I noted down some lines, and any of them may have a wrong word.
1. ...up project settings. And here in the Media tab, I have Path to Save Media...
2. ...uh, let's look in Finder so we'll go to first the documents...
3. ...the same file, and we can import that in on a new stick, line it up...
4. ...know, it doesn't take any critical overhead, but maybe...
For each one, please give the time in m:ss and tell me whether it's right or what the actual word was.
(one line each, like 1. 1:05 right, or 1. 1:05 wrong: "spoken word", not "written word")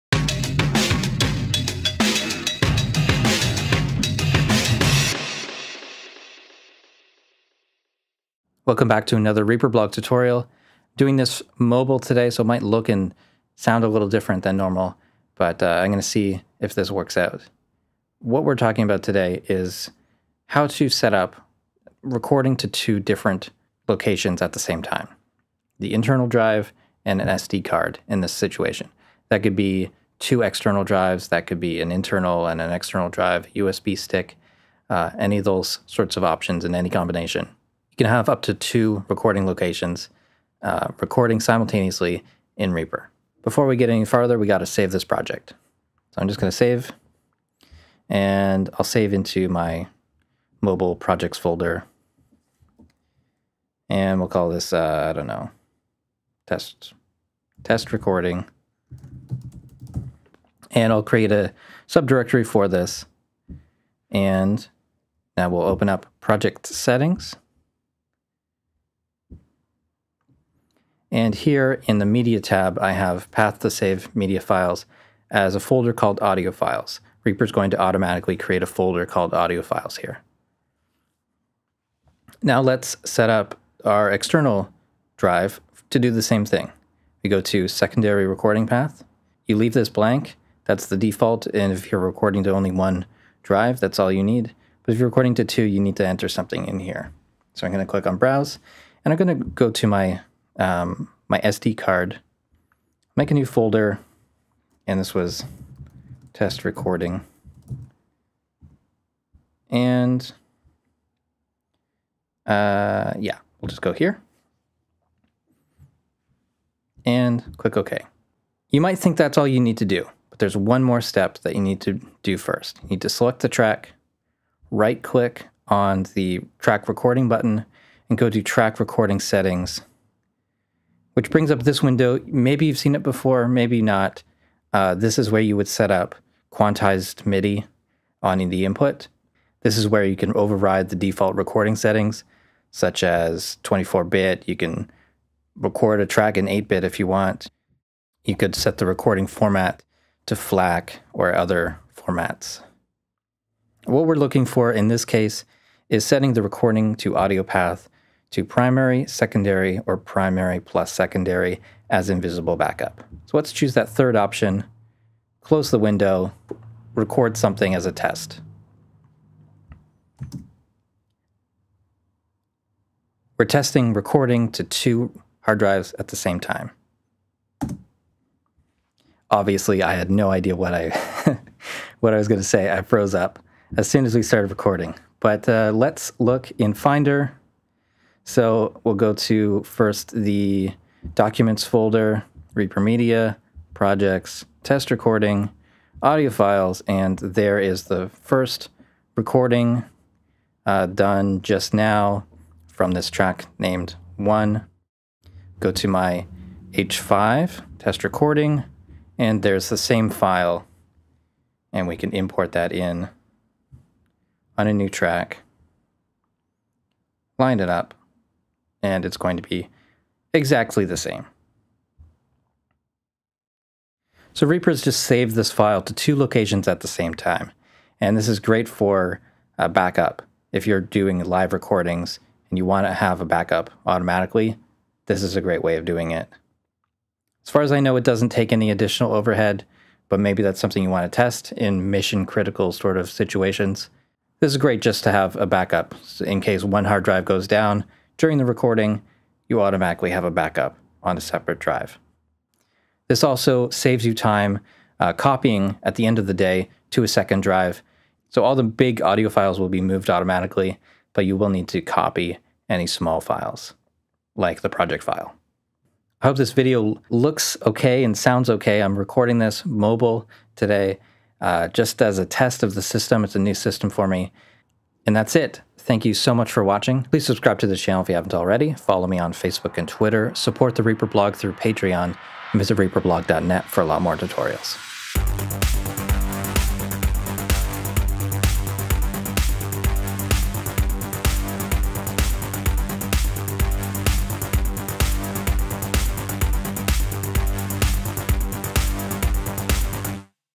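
1. 1:05 right
2. 3:05 right
3. 3:29 wrong: "track", not "stick"
4. 3:57 wrong: "additional", not "critical".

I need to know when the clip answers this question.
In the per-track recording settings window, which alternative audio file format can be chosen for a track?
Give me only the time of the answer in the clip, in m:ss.
2:30.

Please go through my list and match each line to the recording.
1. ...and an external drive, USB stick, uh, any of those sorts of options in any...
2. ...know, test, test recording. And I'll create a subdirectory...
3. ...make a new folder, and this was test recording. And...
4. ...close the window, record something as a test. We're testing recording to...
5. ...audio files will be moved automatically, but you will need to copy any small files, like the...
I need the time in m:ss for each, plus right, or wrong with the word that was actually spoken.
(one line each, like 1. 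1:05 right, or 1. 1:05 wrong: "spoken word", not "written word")
1. 0:32 right
2. 0:55 right
3. 1:43 right
4. 2:45 right
5. 4:19 right.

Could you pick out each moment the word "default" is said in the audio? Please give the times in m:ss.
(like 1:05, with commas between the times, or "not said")
1:30, 2:20.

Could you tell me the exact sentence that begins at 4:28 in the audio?
I'm recording this mobile today, uh, just as a test of the system.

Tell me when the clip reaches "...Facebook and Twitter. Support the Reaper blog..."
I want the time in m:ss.
4:39.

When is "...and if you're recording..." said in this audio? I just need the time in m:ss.
1:31.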